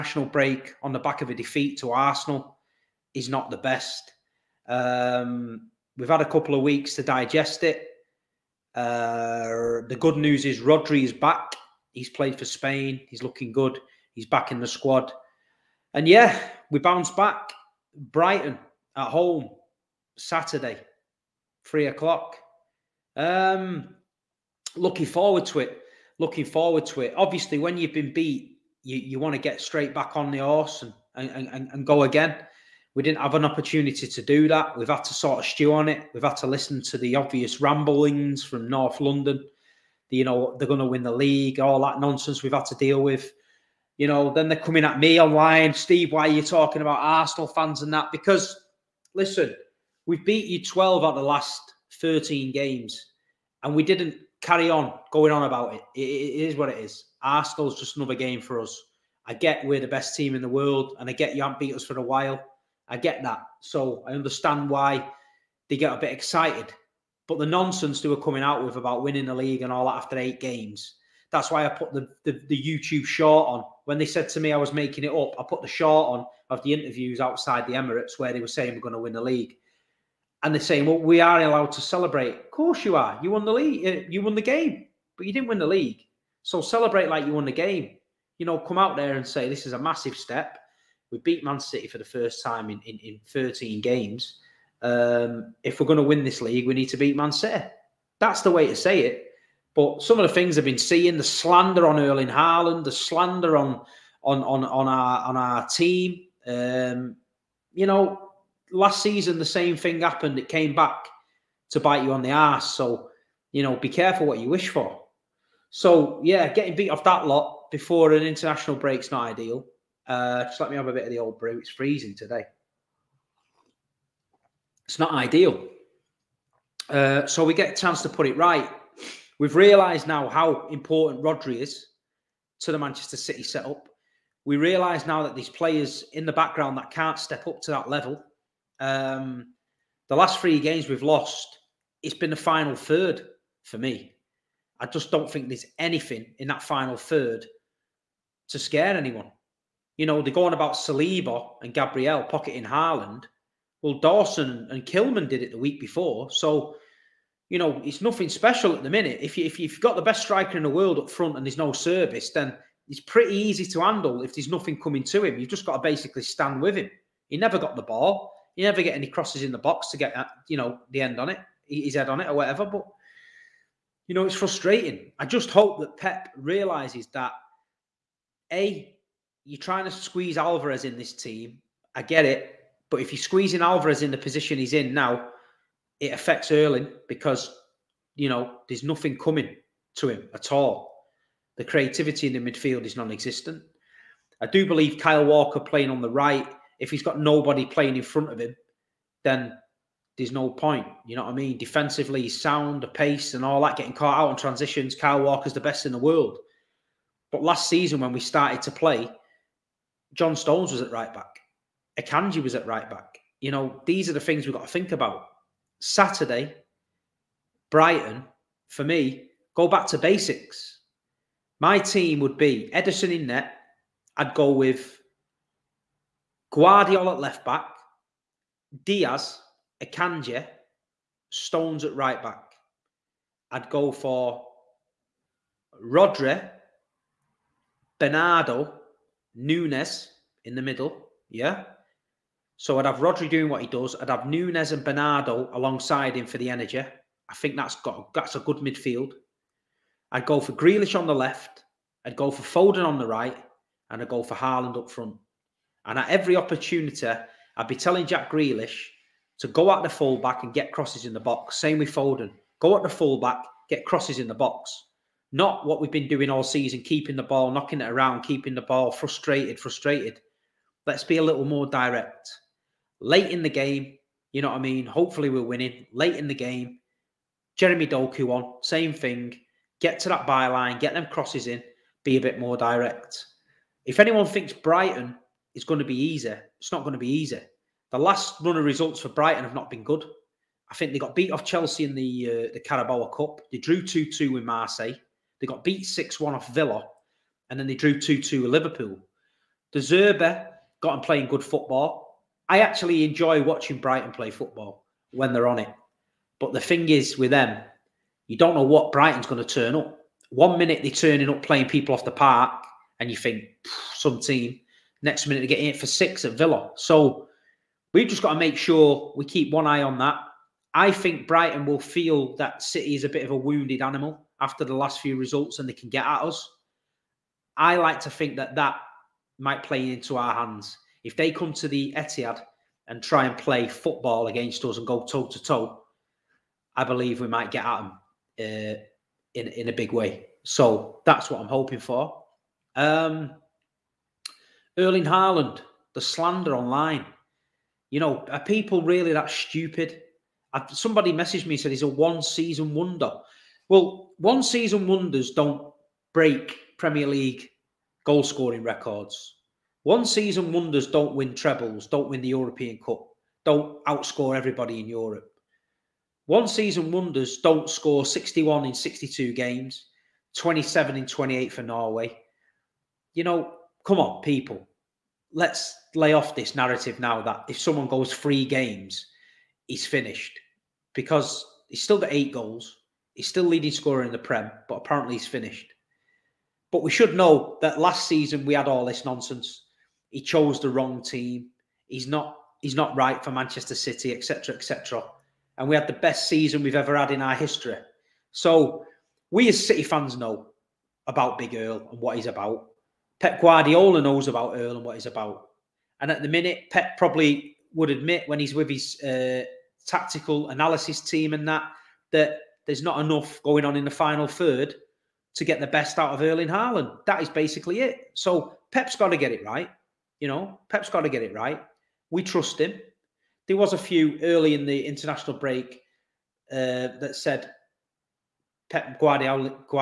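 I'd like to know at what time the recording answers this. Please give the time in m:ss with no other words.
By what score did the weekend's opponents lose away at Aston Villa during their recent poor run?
4:55.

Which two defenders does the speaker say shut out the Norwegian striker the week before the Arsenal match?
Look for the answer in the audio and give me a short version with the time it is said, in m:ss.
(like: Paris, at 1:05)
Dawson and Kilman, at 2:33.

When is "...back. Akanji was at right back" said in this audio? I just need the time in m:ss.
3:31.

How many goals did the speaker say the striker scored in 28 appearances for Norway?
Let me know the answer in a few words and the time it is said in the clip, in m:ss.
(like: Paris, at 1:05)
27, at 6:10.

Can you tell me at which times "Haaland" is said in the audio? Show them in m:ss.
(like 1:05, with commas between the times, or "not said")
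1:42, 2:32, 4:14, 5:45, 6:56.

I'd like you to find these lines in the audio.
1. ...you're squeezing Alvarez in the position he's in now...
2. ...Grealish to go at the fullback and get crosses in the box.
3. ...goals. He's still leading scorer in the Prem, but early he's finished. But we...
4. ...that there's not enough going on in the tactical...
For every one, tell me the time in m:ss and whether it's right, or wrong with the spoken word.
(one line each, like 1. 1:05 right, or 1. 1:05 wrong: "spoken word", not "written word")
1. 3:03 right
2. 4:18 right
3. 6:22 wrong: "apparently", not "early"
4. 6:52 wrong: "final", not "tactical".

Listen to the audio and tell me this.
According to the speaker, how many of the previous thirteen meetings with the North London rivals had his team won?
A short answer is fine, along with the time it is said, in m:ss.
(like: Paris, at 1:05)
12, at 0:50.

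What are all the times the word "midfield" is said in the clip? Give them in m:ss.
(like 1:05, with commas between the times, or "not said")
3:12, 4:08.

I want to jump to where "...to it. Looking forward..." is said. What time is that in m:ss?
0:25.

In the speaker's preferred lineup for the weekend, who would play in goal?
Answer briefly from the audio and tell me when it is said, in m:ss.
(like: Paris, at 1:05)
Ederson, at 3:42.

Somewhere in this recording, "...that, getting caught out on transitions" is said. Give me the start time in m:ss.
3:23.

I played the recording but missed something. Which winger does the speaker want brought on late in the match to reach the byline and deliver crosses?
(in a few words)
Jeremy Doku.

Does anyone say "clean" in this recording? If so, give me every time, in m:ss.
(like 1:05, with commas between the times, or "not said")
not said.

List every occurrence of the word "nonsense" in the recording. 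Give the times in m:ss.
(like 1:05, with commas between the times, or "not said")
0:41, 1:07, 6:29.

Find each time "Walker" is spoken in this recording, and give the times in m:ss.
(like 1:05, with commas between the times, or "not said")
3:15, 3:25.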